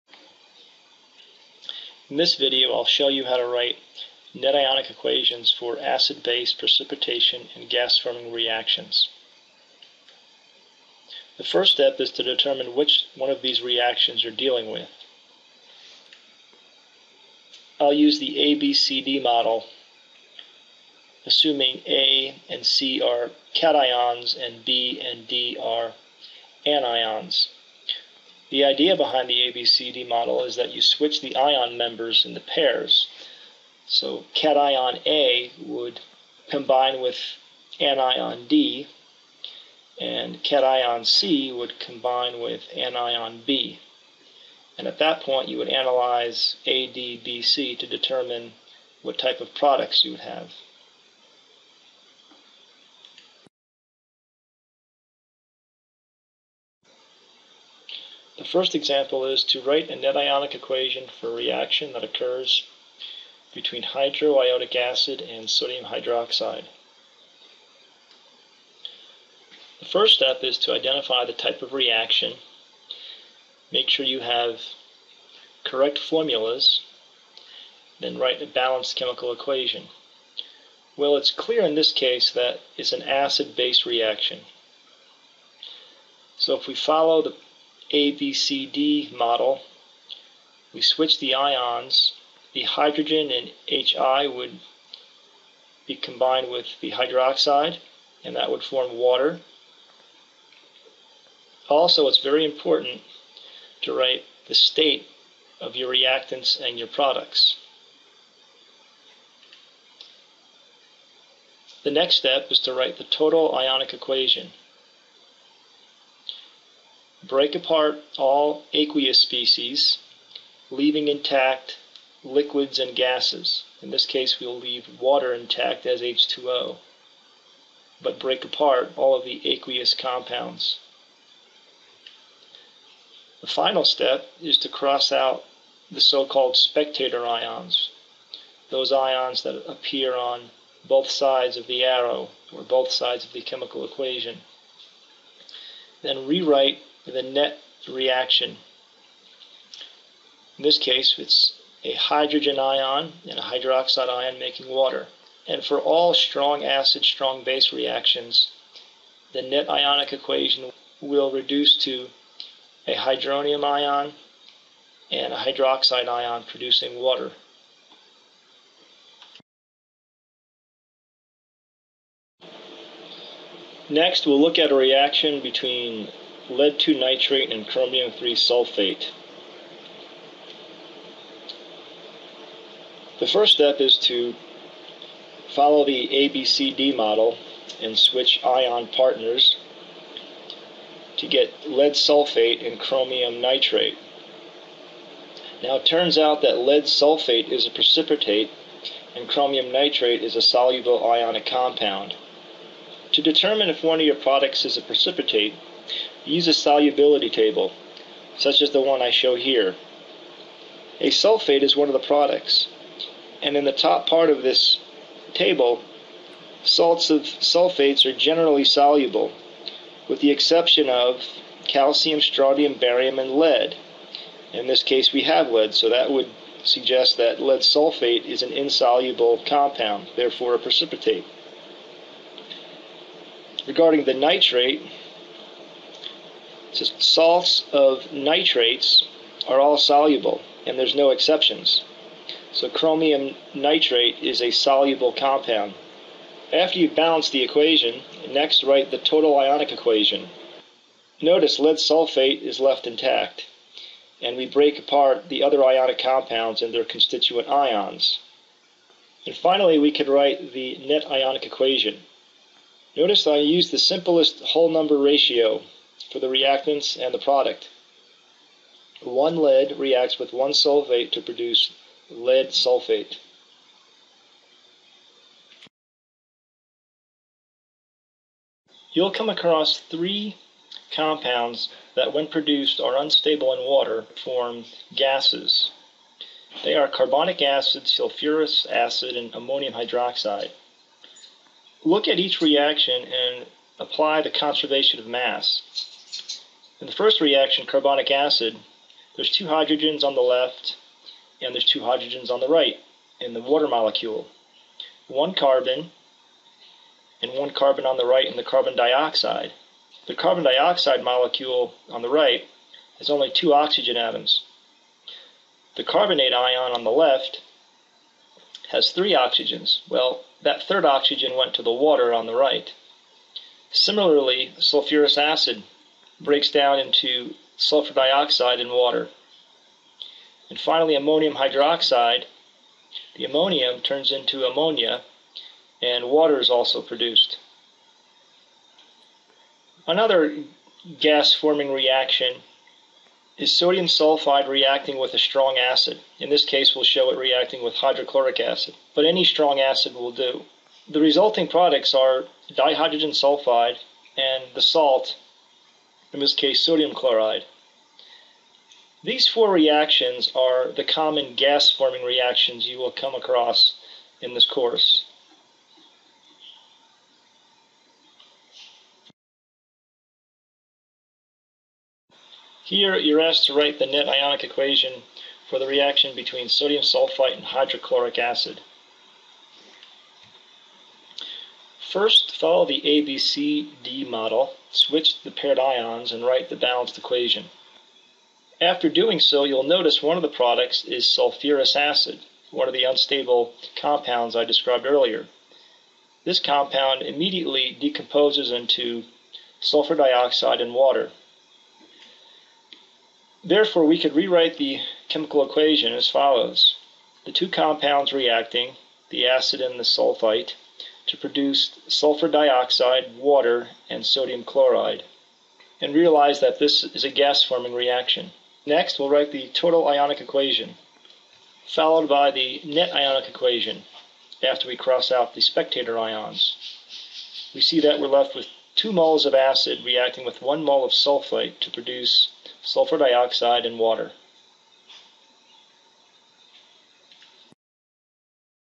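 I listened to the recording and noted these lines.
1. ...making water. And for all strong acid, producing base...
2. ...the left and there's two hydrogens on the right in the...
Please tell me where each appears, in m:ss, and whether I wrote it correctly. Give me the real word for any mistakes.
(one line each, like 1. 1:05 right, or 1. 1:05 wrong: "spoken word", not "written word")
1. 2:34 wrong: "strong", not "producing"
2. 5:00 right.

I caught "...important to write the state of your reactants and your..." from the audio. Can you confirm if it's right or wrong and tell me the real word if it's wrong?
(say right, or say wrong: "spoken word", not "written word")
right.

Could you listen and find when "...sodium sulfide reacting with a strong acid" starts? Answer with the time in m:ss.
5:43.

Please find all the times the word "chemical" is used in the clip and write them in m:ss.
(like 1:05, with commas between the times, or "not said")
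1:18, 2:23, 6:45.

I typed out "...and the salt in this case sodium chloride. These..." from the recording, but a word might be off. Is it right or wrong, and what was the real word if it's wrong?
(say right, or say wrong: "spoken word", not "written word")
right.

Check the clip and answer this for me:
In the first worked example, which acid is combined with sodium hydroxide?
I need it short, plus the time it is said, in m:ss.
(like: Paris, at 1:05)
Hydroiodic acid, at 1:03.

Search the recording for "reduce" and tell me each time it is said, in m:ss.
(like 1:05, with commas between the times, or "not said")
2:41.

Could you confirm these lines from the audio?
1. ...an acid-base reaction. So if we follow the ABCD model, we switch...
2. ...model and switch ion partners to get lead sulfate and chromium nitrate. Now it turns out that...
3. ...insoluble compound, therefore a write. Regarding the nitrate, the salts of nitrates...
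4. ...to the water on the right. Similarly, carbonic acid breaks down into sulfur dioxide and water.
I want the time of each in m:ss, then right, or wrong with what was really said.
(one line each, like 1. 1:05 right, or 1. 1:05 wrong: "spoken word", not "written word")
1. 1:22 right
2. 3:06 right
3. 3:48 wrong: "precipitate", not "write"
4. 5:21 wrong: "sulfuric", not "carbonic".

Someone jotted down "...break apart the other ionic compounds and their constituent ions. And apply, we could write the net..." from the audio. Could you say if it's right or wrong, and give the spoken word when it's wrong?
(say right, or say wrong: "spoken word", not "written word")
wrong: "finally", not "apply".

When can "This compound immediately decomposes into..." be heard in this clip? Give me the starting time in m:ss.
6:36.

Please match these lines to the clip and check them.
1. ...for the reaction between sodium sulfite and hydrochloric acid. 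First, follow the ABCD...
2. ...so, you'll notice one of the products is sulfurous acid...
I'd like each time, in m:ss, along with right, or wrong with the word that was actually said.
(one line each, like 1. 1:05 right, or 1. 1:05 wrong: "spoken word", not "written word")
1. 6:15 right
2. 6:29 right.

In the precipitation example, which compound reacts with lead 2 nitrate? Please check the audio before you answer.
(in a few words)
Chromium 3 sulfate.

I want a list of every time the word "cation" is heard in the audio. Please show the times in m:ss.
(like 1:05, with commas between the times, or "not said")
0:23, 0:34, 0:40.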